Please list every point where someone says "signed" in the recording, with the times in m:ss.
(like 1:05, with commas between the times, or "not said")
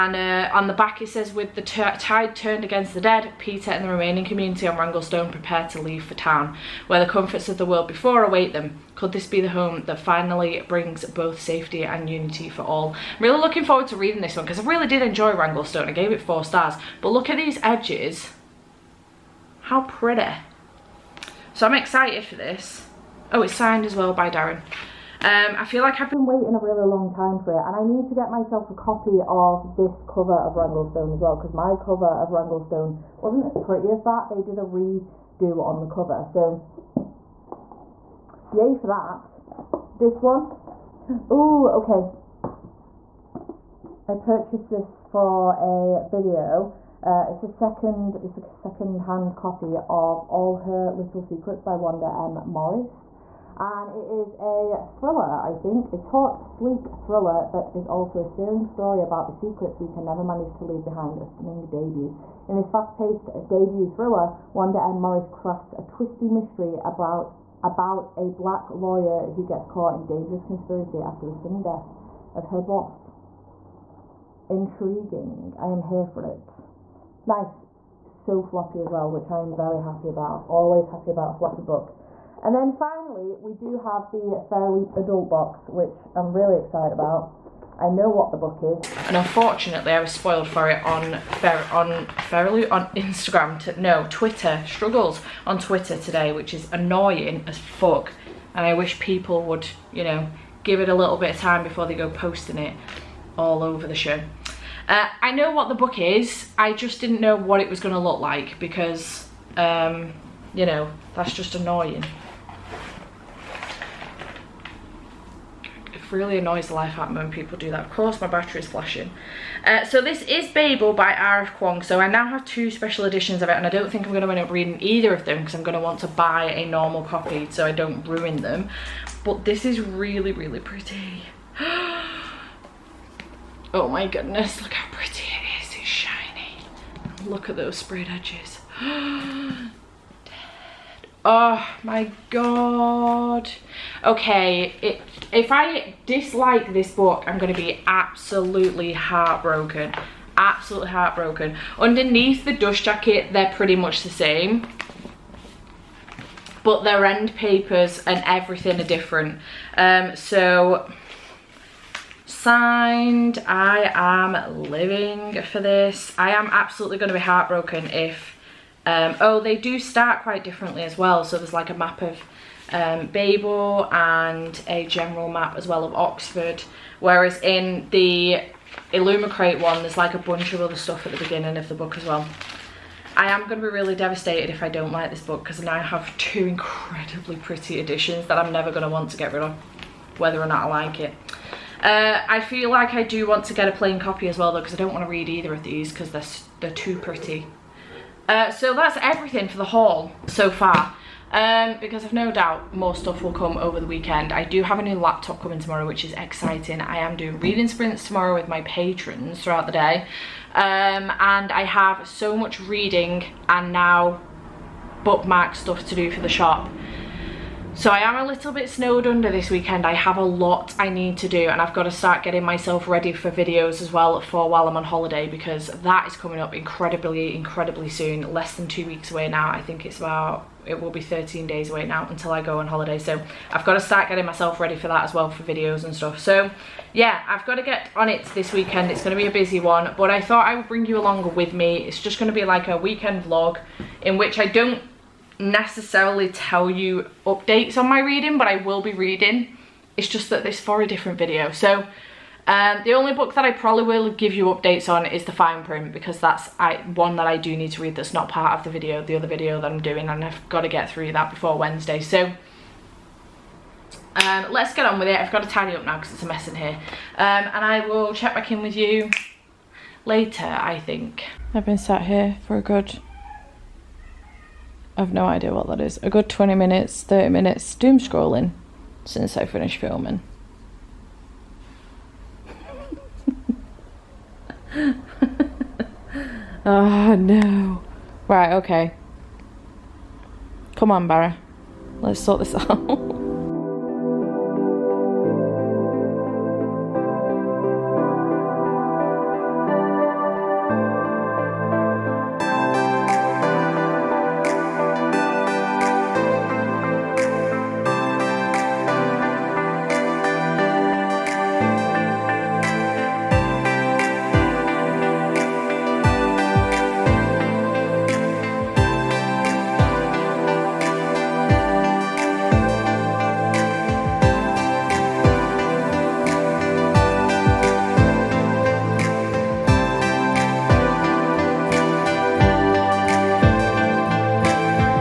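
0:23, 2:42.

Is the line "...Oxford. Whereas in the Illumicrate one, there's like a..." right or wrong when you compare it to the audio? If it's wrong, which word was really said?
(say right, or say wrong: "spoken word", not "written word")
right.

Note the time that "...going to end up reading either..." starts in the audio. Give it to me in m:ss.
2:04.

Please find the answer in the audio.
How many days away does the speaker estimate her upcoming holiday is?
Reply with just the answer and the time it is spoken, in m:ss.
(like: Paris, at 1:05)
13, at 3:51.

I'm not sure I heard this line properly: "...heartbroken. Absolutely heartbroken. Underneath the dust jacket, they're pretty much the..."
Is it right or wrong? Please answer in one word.
right.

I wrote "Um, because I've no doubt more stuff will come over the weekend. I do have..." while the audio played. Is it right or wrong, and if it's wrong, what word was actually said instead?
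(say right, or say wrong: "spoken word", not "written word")
right.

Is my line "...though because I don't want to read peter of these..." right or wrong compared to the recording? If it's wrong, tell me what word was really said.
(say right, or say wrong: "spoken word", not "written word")
wrong: "either", not "peter".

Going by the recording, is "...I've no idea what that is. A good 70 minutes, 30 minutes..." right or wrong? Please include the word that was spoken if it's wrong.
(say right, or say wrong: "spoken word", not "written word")
wrong: "20", not "70".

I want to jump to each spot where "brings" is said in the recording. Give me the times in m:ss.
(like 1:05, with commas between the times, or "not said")
0:10, 4:00.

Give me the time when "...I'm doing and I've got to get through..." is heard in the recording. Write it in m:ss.
4:19.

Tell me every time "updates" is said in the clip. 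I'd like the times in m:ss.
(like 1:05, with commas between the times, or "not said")
4:07, 4:14.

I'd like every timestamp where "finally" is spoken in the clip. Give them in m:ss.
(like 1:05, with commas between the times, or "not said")
0:09, 1:22.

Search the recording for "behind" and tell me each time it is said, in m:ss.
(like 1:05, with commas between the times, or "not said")
1:00.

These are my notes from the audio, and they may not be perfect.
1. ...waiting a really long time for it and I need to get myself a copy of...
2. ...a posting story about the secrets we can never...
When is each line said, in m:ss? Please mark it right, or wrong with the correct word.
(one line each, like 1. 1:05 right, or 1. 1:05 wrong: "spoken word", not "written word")
1. 0:26 right
2. 0:58 wrong: "searing", not "posting".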